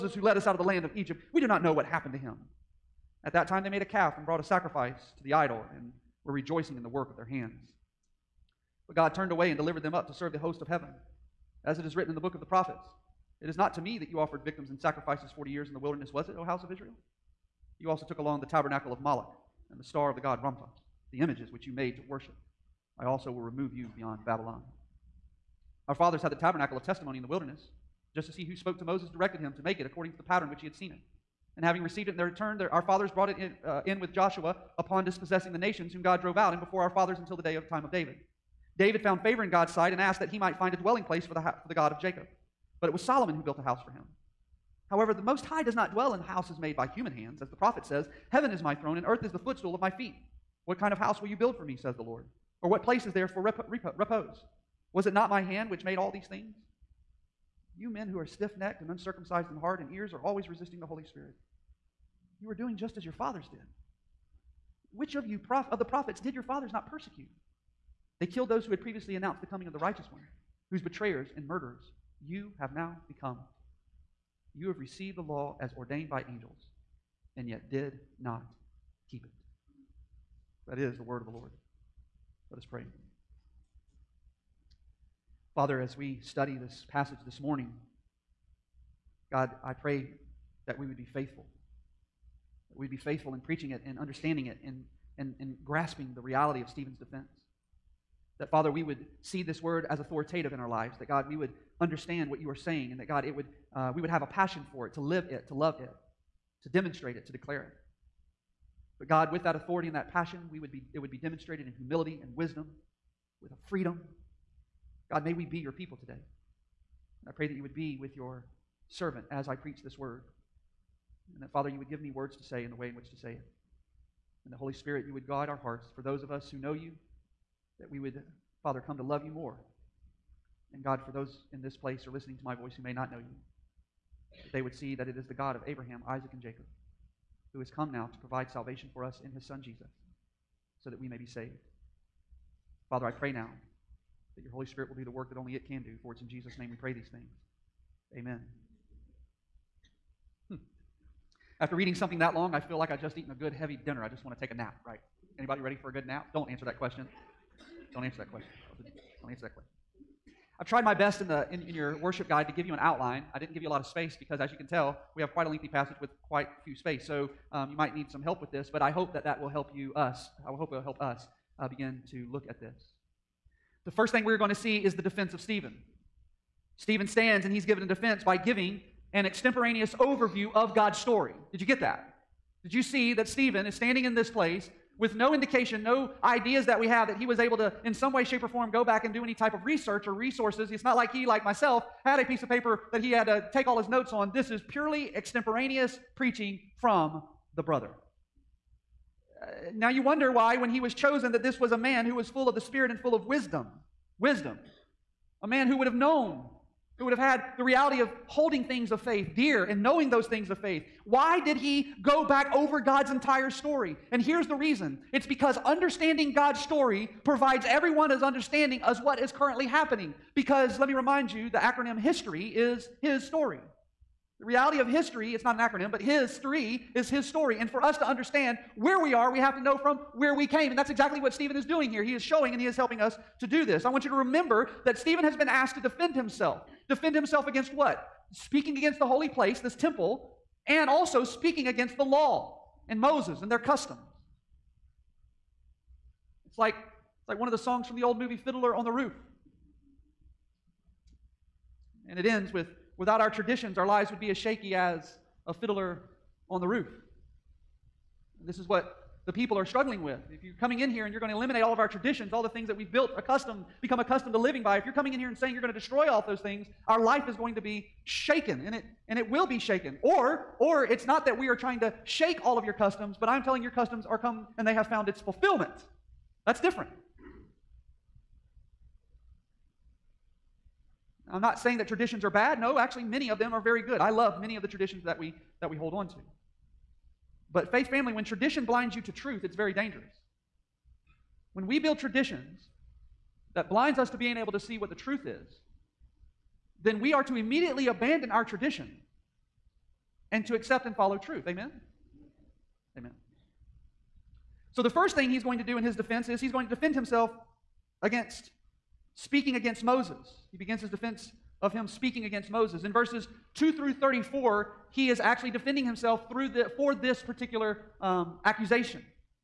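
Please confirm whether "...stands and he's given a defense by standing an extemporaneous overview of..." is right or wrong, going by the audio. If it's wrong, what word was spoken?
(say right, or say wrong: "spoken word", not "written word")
wrong: "giving", not "standing".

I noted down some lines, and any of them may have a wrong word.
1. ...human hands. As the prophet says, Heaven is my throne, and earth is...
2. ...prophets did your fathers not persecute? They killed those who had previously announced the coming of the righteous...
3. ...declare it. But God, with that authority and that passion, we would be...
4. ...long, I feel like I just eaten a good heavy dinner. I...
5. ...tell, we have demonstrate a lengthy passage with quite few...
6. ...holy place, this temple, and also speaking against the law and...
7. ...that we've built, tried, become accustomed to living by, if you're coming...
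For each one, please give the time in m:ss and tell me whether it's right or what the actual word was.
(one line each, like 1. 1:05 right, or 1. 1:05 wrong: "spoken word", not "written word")
1. 0:46 right
2. 1:05 right
3. 1:47 right
4. 2:32 right
5. 2:44 wrong: "quite", not "demonstrate"
6. 3:59 right
7. 4:22 wrong: "accustomed", not "tried".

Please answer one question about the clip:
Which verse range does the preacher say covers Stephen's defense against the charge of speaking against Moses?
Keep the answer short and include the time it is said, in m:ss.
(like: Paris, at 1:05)
2 through 34, at 5:13.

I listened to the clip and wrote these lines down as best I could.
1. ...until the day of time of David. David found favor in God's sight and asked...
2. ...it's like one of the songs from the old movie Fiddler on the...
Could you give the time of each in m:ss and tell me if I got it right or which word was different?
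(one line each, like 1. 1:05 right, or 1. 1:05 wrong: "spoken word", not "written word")
1. 0:37 right
2. 4:06 right.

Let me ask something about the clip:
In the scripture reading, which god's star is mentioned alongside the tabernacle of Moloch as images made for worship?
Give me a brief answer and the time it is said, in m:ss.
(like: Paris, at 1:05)
Rompha, at 0:20.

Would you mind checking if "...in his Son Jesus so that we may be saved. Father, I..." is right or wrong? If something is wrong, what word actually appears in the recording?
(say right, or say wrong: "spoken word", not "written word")
right.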